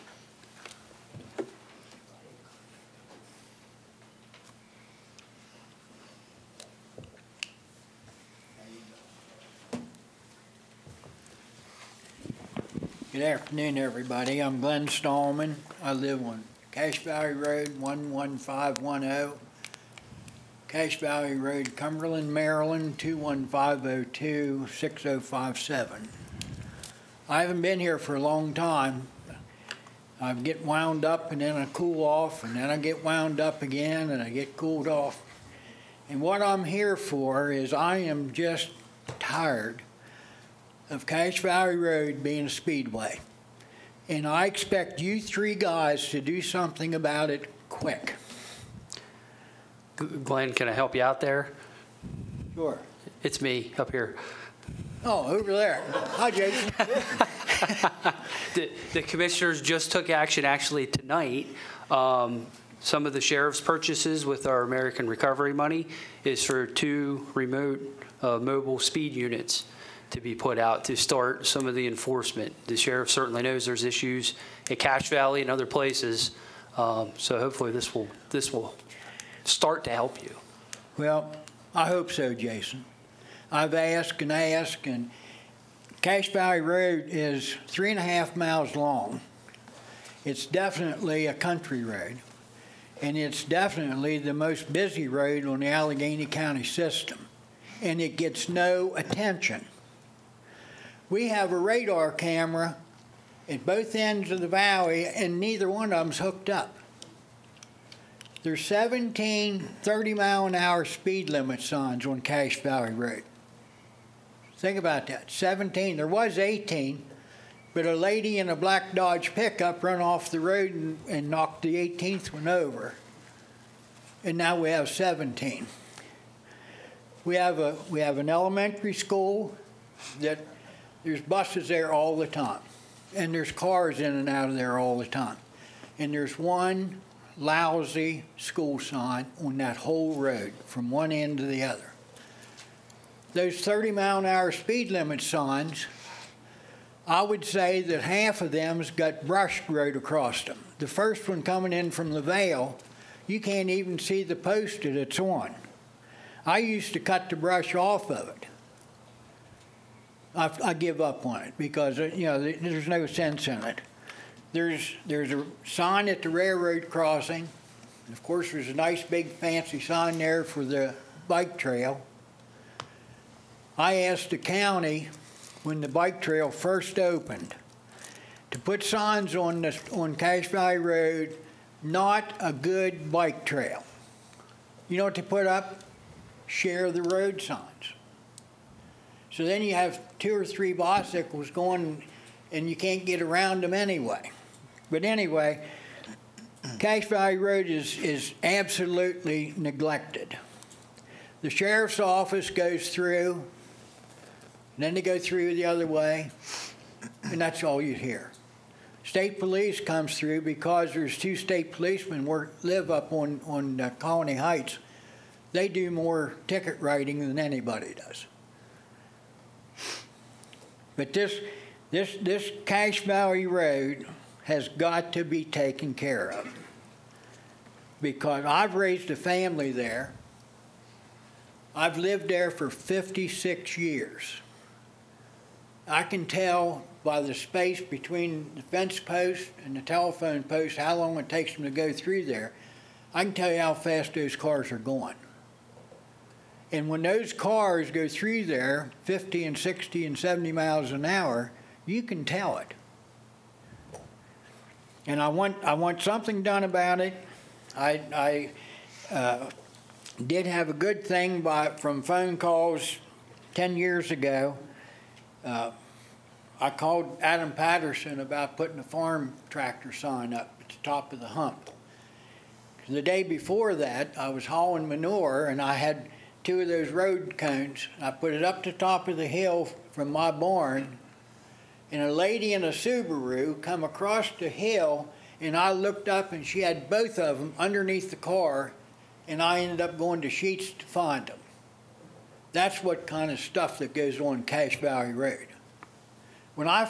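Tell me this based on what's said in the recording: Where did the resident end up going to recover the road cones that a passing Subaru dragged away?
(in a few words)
Sheetz.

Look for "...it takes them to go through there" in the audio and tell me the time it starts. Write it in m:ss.
4:01.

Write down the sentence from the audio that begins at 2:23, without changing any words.
Those 30 mile an hour speed limit signs, I would say that half of them's got brush right across them.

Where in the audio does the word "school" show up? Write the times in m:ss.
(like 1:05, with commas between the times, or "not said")
2:08, 2:18.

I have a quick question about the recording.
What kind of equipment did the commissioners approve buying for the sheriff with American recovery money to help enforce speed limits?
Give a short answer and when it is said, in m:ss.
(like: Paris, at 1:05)
mobile speed units, at 1:08.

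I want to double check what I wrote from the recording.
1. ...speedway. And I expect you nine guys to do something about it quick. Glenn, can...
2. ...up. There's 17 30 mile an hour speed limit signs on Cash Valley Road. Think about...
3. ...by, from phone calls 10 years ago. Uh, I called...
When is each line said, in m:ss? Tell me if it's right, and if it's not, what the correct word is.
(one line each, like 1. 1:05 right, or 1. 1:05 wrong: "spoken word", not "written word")
1. 0:42 wrong: "three", not "nine"
2. 1:46 right
3. 4:21 right.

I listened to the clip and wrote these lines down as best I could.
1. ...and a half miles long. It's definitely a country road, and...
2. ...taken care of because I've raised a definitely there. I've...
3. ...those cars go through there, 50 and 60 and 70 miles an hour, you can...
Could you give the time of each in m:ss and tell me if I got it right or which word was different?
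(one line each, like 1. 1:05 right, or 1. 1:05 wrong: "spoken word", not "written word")
1. 1:27 right
2. 3:45 wrong: "family", not "definitely"
3. 4:07 right.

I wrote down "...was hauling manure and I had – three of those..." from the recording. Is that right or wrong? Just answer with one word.
wrong.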